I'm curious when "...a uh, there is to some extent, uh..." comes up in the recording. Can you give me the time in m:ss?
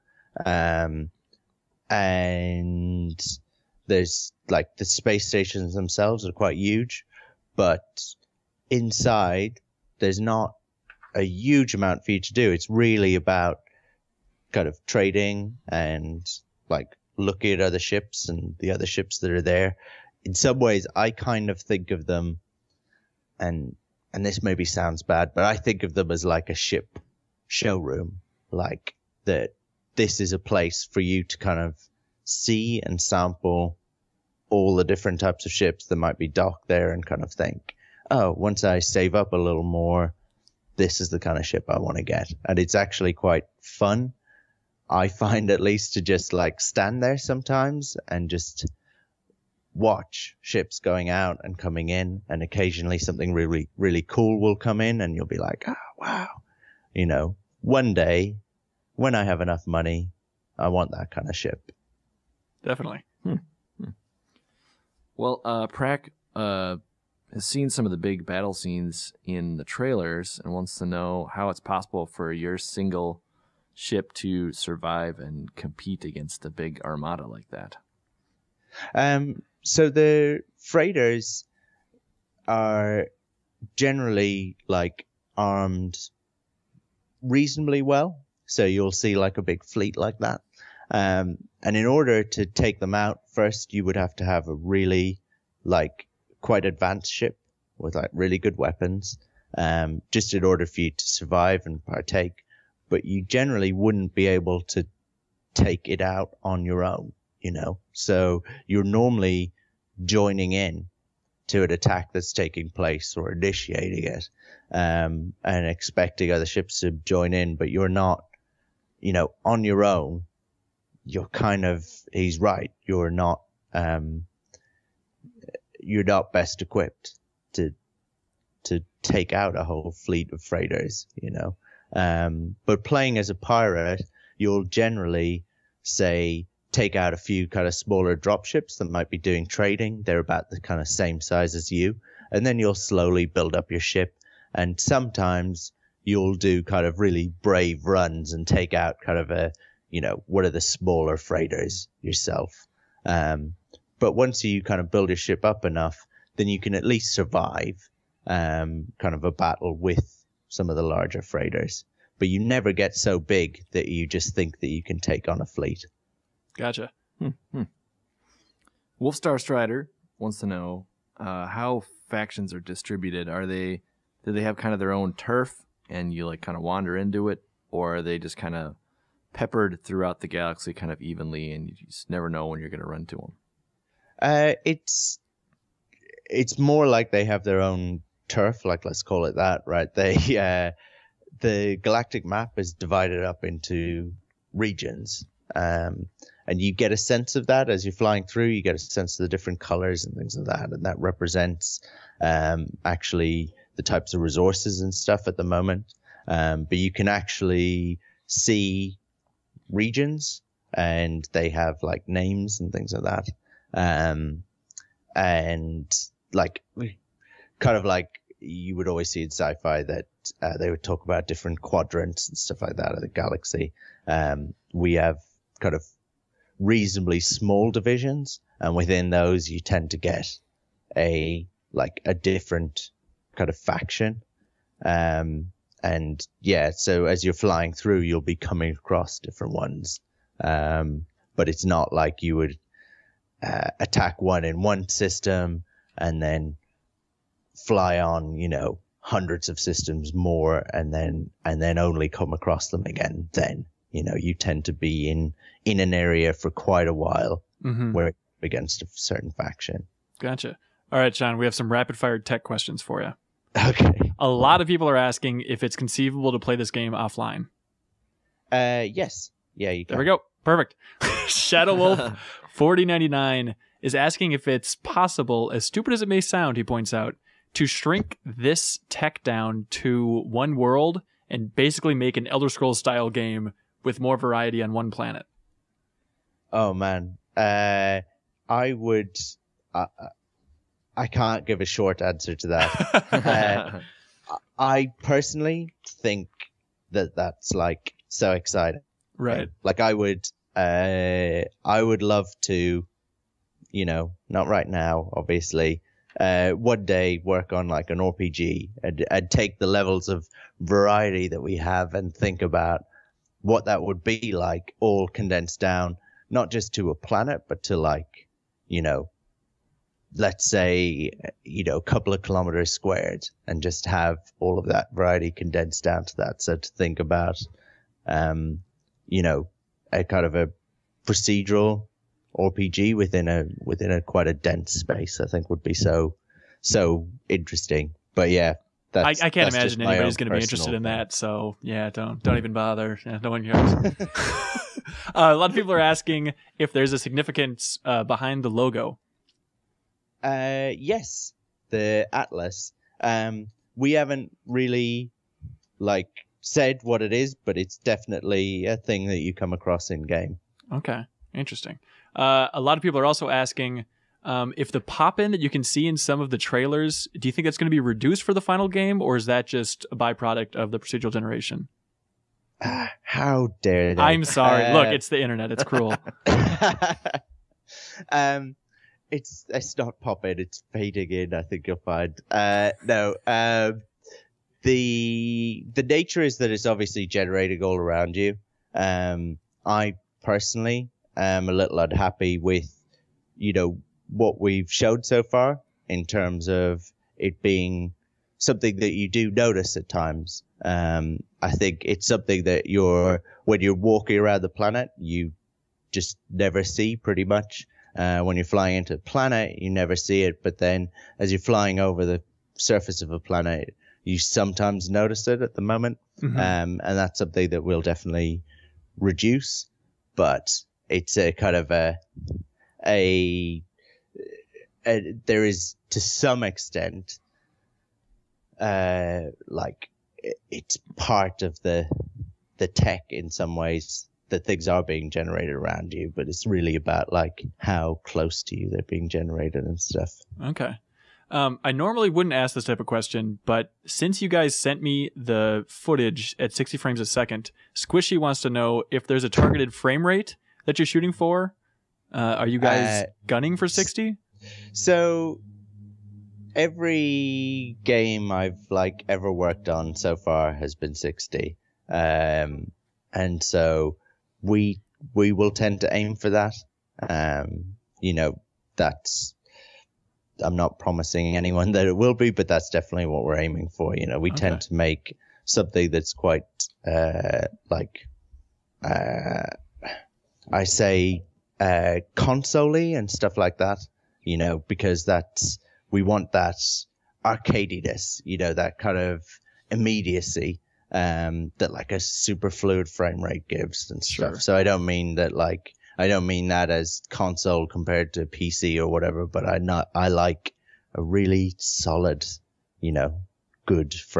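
7:02.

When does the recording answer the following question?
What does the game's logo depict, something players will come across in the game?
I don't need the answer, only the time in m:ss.
5:51.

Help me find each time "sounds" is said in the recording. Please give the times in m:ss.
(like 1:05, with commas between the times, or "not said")
0:24, 4:36.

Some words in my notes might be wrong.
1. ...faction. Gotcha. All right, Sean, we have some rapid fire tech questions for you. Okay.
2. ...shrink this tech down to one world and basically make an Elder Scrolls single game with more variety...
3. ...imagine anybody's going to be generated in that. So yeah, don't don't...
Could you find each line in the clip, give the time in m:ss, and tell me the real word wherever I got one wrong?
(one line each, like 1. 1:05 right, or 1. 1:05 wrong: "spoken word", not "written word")
1. 4:19 right
2. 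4:37 wrong: "style", not "single"
3. 5:39 wrong: "interested", not "generated".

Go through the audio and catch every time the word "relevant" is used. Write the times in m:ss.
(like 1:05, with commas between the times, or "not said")
not said.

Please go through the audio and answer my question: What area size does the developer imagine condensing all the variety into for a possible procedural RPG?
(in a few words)
A couple of kilometers squared.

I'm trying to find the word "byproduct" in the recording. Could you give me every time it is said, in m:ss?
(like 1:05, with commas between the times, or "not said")
6:09.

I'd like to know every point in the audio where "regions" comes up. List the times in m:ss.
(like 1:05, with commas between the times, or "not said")
3:14, 3:29.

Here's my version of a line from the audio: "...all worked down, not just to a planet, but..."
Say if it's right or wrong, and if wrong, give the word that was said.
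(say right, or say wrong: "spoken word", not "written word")
wrong: "condensed", not "worked".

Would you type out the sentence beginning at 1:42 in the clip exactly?
But you generally wouldn't be able to take it out on your own, you know.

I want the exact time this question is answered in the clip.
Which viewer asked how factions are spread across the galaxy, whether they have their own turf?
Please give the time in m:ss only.
2:49.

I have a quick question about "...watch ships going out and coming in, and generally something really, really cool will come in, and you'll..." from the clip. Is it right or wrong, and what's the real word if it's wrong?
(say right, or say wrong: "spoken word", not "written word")
wrong: "occasionally", not "generally".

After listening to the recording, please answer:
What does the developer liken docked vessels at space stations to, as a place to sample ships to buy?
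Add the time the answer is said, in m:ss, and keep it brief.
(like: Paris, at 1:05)
A ship showroom, at 0:26.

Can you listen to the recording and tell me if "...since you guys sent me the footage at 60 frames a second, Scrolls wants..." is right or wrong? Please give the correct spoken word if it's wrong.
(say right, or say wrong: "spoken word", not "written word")
wrong: "Squishy", not "Scrolls".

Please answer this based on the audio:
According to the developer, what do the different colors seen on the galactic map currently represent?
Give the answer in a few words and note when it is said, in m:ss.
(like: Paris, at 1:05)
Types of resources, at 3:23.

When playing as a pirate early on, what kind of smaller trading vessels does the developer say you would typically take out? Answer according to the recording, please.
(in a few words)
Drop ships.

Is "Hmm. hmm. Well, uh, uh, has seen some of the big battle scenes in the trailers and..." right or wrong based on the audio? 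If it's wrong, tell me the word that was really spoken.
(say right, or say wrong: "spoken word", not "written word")
right.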